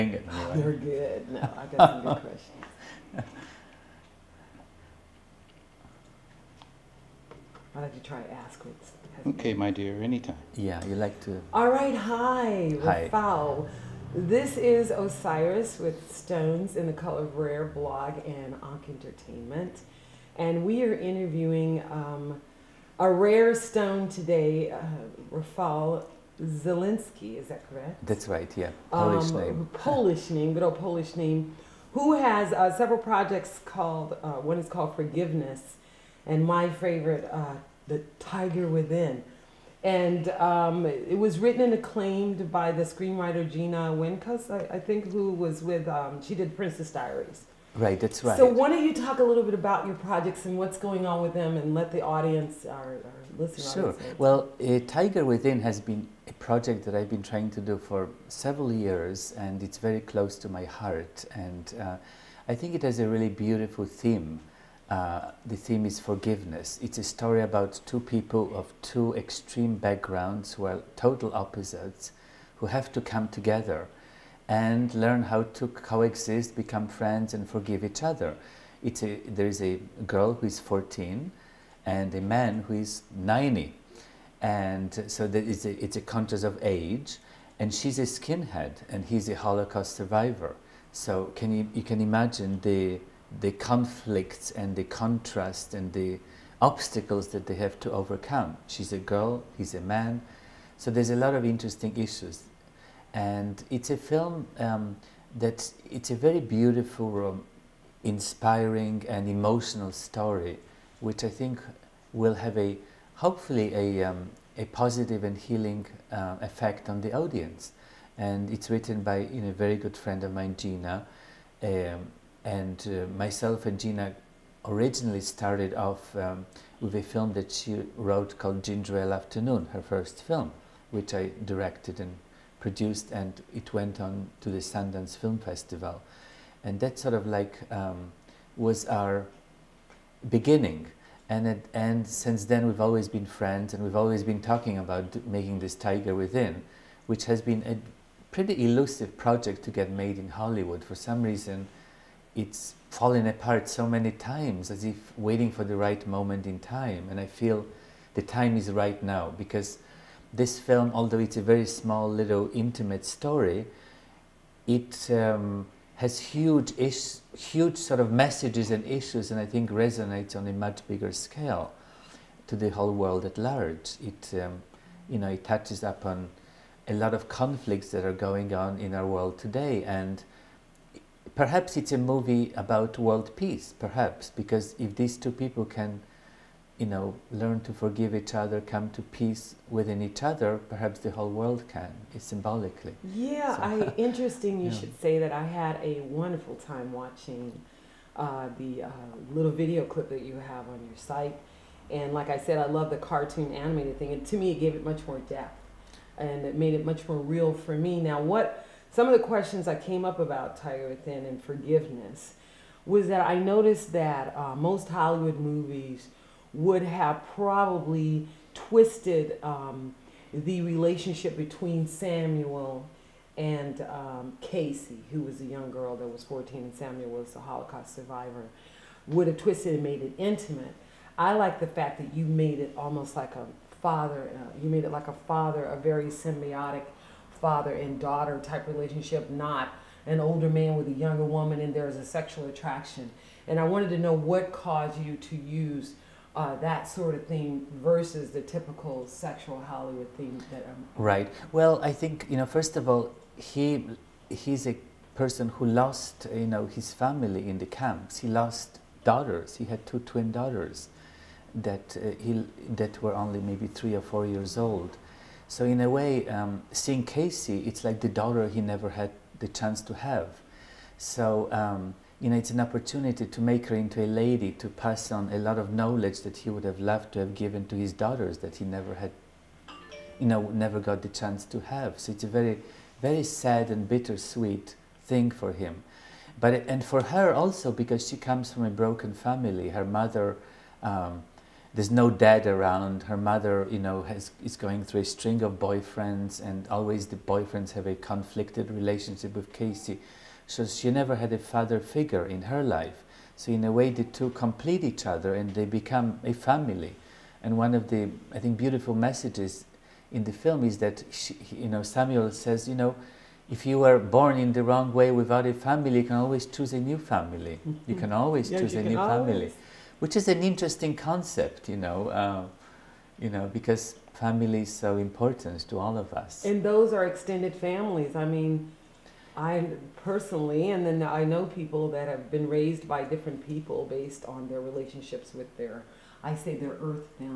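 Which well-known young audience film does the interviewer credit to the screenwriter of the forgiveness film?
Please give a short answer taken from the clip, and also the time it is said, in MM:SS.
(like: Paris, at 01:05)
Princess Diaries, at 00:46.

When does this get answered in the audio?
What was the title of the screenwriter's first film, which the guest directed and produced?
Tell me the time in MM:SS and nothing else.
02:08.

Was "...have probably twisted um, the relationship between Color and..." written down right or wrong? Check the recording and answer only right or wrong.
wrong.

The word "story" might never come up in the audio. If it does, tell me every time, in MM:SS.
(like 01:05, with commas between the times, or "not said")
01:07, 01:49, 02:43.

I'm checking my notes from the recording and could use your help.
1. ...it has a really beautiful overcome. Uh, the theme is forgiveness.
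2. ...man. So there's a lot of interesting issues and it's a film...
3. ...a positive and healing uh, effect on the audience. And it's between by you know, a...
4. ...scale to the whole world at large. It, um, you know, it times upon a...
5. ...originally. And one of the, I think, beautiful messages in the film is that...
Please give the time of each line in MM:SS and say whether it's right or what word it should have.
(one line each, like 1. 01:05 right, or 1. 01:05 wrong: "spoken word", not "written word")
1. 01:02 wrong: "theme", not "overcome"
2. 01:39 right
3. 01:54 wrong: "written", not "between"
4. 02:51 wrong: "touches", not "times"
5. 05:06 wrong: "family", not "originally".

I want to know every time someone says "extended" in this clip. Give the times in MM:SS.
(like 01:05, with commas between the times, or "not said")
05:27.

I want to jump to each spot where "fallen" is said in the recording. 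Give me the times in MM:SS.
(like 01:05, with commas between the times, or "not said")
02:32.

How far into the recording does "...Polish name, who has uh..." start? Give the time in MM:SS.
00:30.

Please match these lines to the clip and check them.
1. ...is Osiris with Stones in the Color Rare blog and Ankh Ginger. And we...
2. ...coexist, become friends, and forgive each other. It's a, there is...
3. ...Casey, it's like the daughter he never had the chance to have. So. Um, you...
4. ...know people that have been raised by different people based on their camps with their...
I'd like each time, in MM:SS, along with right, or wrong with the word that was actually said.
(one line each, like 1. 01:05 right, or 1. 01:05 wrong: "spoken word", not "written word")
1. 00:14 wrong: "Entertainment", not "Ginger"
2. 01:15 right
3. 04:27 right
4. 05:31 wrong: "relationships", not "camps".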